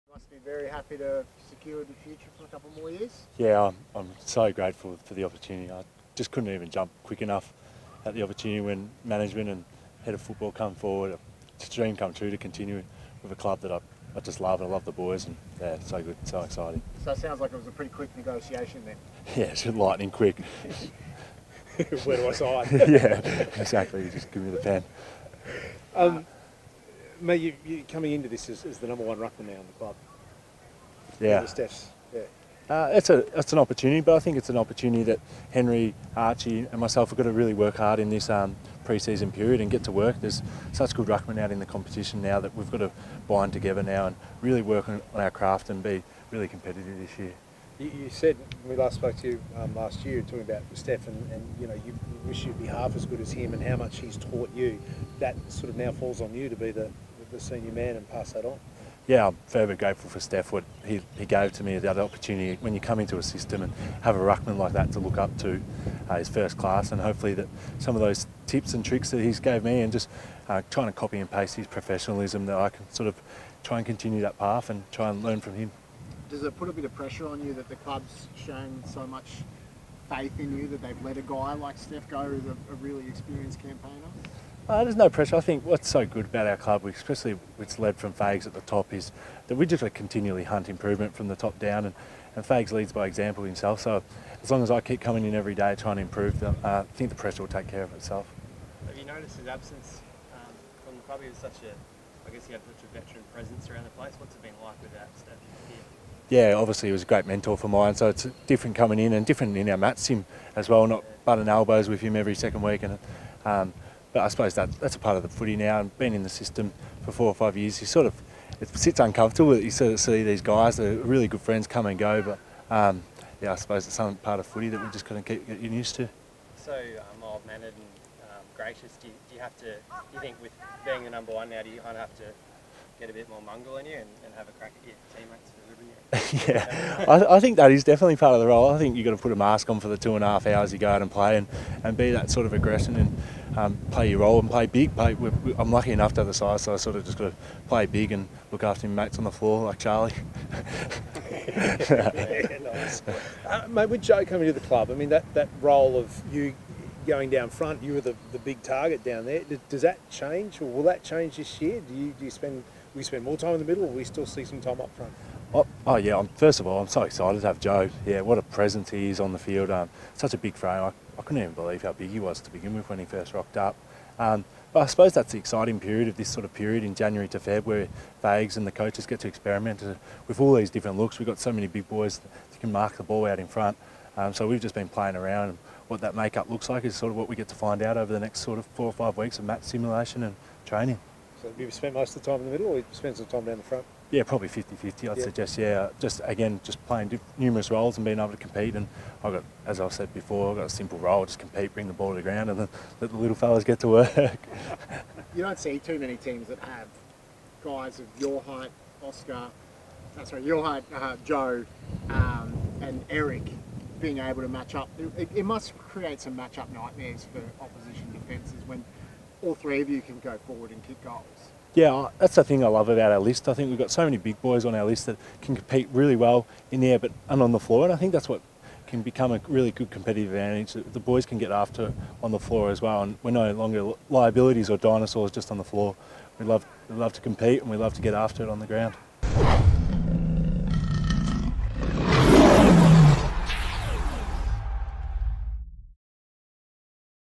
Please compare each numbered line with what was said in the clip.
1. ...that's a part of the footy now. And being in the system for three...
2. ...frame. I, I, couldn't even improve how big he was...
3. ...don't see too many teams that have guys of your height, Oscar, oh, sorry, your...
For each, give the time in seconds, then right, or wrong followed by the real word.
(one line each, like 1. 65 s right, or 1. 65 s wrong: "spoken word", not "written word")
1. 114 s wrong: "four", not "three"
2. 170 s wrong: "believe", not "improve"
3. 205 s right.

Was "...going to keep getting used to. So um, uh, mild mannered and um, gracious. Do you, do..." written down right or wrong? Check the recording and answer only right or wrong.
right.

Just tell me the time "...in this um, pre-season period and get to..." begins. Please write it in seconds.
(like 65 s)
37 s.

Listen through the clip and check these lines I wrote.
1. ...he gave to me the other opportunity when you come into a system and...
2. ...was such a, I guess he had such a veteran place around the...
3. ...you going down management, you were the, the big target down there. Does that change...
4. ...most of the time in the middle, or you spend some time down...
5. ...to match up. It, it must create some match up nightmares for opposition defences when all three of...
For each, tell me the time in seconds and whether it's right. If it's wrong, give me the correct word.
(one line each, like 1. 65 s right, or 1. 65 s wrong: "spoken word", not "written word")
1. 61 s right
2. 101 s wrong: "presence", not "place"
3. 156 s wrong: "front", not "management"
4. 191 s right
5. 214 s right.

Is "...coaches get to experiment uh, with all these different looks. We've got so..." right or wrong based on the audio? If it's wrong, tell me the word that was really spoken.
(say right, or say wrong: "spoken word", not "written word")
right.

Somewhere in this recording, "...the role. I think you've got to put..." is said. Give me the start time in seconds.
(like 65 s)
138 s.